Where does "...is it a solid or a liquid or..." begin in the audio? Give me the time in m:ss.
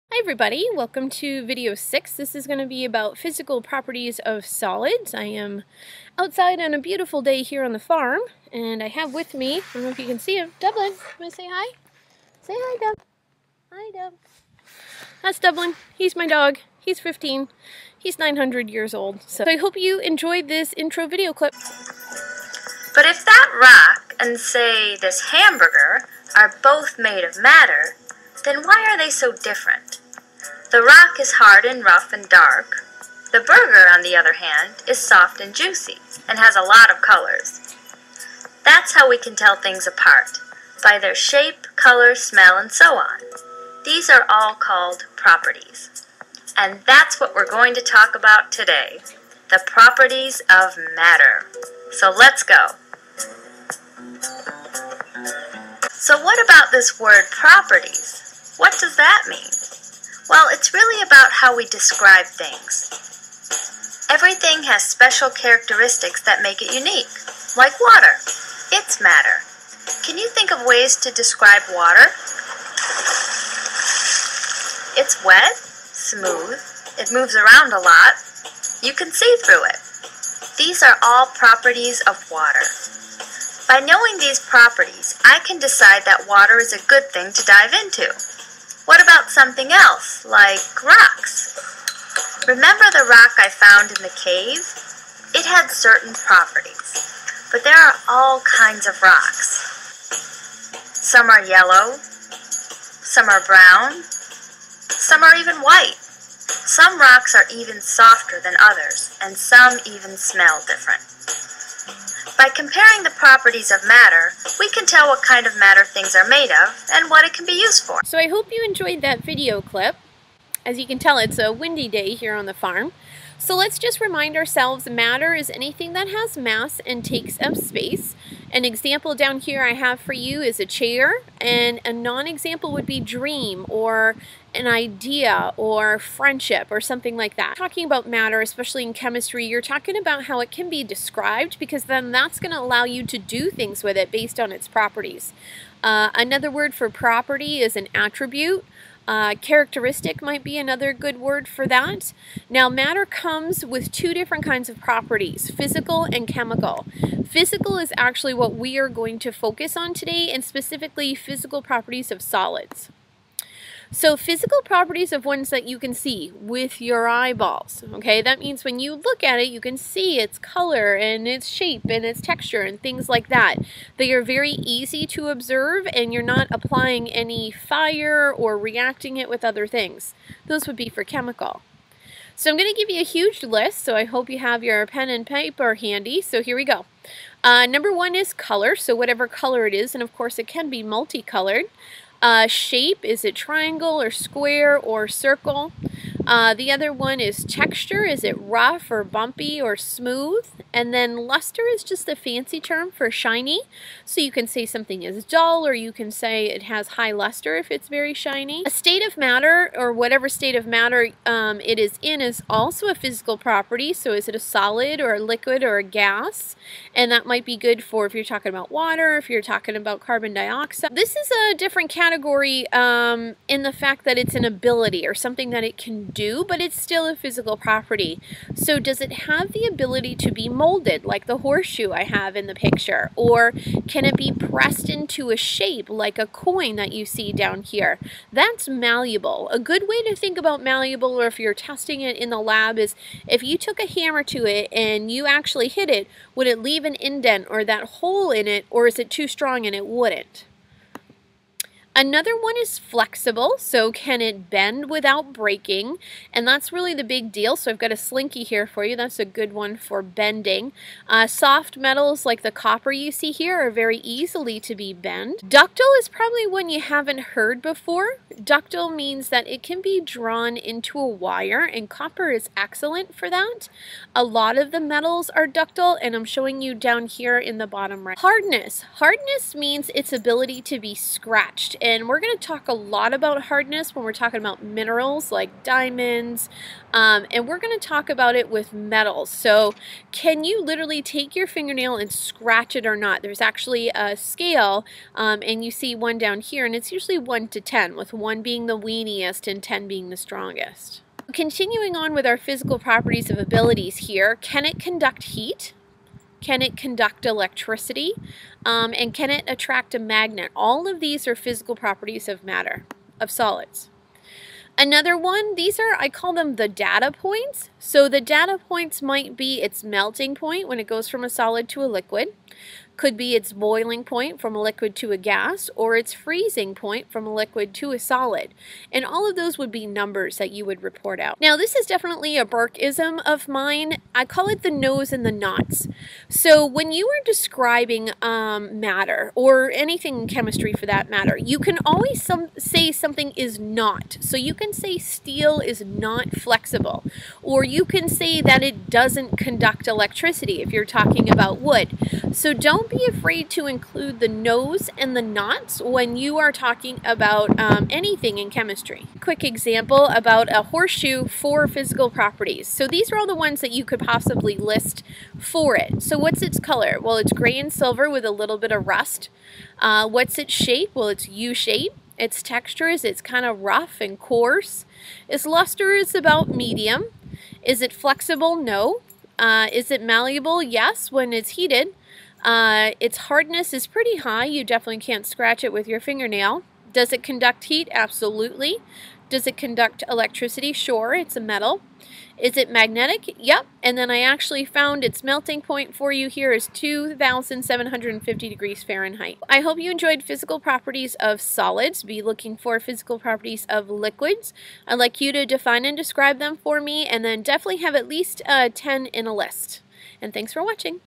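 3:34.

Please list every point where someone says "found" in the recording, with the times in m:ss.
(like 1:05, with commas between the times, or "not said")
1:33, 6:34.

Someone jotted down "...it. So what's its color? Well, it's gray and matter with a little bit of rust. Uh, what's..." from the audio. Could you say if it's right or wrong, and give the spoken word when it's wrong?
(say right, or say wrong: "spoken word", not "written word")
wrong: "silver", not "matter".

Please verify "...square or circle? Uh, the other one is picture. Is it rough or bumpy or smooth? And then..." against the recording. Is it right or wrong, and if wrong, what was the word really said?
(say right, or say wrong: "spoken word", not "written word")
wrong: "texture", not "picture".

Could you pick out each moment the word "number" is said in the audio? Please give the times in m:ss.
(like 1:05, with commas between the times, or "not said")
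3:07, 5:29.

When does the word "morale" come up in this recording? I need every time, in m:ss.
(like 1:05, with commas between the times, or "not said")
not said.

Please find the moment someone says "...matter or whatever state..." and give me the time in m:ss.
3:29.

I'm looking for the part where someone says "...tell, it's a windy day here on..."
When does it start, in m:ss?
2:00.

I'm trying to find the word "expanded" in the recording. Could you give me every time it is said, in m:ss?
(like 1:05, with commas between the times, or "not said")
not said.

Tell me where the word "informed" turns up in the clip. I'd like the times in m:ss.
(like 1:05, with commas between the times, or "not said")
not said.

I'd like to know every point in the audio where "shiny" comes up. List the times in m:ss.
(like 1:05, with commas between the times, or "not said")
3:23, 3:28.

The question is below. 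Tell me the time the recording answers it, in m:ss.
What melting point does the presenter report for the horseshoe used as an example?
6:36.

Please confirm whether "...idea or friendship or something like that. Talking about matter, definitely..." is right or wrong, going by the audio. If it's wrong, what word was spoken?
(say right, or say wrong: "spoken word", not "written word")
wrong: "especially", not "definitely".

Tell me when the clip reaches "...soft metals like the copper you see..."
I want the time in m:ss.
4:21.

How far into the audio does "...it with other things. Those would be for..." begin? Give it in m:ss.
2:59.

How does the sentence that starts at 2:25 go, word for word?
Uh, another word for property is an attribute.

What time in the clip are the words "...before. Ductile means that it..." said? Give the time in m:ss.
4:27.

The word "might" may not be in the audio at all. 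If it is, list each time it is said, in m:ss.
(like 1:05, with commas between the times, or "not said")
2:30, 3:37, 5:19.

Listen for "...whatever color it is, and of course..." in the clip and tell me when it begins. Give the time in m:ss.
3:08.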